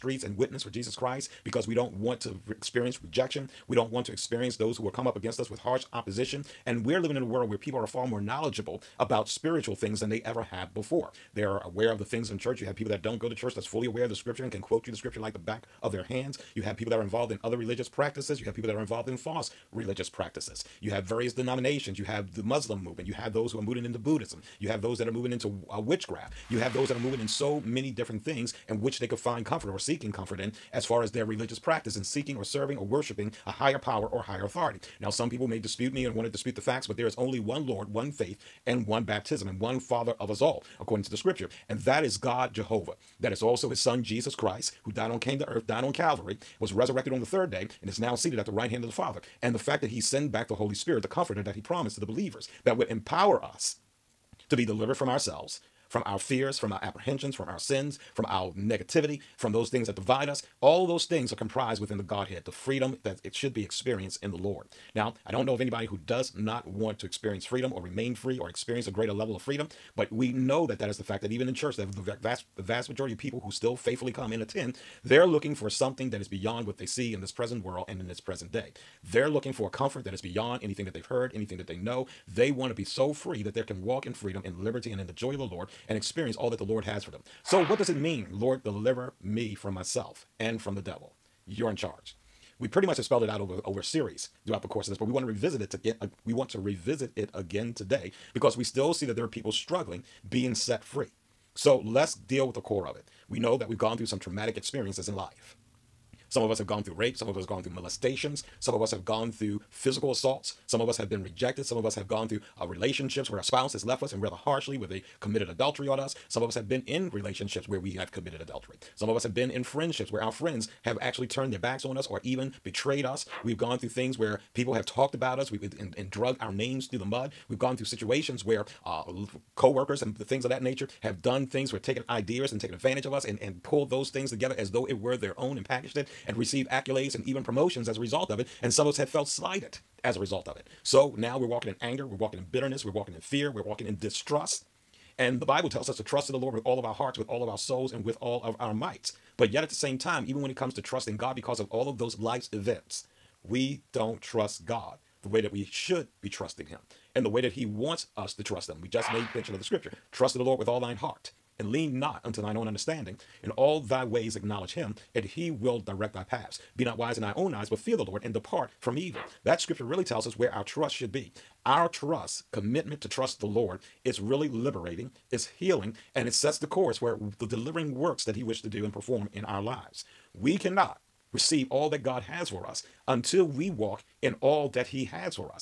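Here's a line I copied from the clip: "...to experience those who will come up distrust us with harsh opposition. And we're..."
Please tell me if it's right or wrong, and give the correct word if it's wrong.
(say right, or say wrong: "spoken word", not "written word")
wrong: "against", not "distrust".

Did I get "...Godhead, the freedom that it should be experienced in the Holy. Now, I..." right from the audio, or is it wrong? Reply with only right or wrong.
wrong.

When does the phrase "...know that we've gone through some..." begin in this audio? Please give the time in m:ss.
1:43.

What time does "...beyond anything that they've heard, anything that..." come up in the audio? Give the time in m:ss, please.
1:20.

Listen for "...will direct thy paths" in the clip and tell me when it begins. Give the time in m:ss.
2:45.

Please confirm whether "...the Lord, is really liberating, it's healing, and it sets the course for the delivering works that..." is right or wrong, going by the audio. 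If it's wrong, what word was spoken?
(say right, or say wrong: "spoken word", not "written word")
right.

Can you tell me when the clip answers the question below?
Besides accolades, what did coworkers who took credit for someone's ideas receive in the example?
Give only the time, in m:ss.
2:17.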